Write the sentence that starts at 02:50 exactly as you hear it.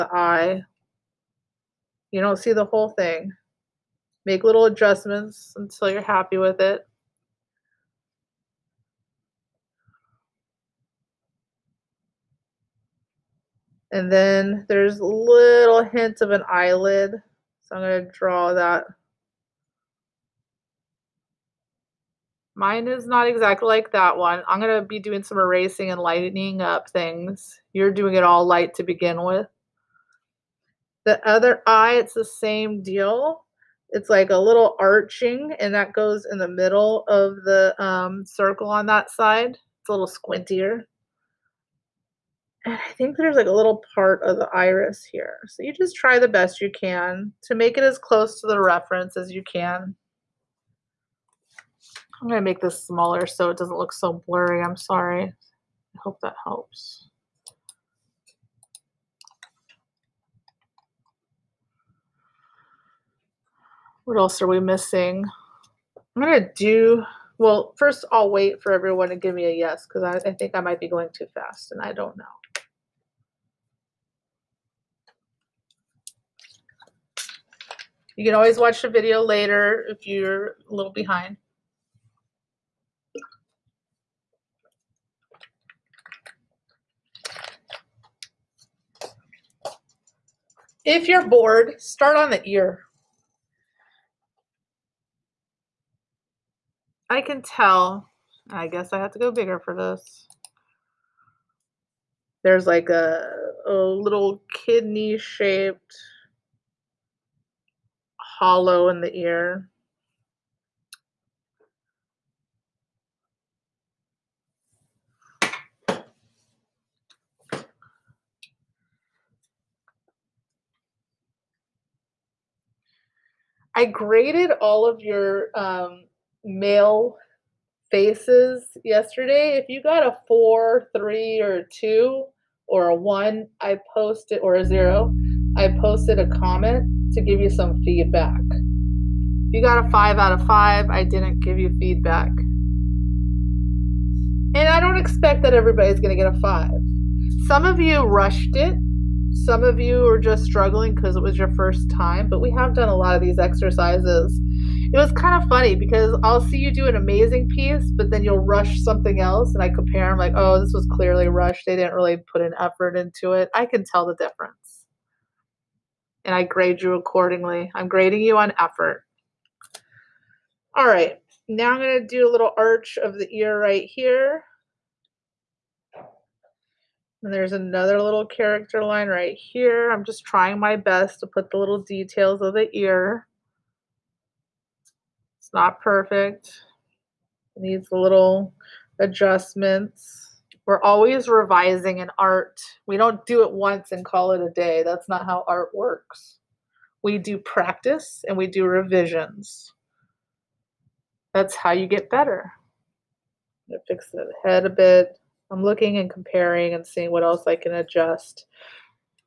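All right, now I'm going to do a little arch of the ear right here.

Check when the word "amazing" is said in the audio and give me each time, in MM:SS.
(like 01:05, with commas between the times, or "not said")
02:36.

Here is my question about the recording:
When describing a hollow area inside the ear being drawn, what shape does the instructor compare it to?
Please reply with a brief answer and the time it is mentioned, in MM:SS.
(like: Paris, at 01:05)
kidney shaped, at 01:44.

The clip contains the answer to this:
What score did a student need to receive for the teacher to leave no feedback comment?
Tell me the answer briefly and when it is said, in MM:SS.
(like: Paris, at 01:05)
5 out of 5, at 02:19.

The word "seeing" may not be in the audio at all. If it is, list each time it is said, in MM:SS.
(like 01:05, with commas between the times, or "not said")
03:26.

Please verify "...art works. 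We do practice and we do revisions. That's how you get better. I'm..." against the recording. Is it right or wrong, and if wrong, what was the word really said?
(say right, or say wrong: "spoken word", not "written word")
right.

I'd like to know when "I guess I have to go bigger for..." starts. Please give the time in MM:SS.
01:38.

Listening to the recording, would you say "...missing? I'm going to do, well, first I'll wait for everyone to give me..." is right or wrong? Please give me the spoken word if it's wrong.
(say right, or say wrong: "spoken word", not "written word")
right.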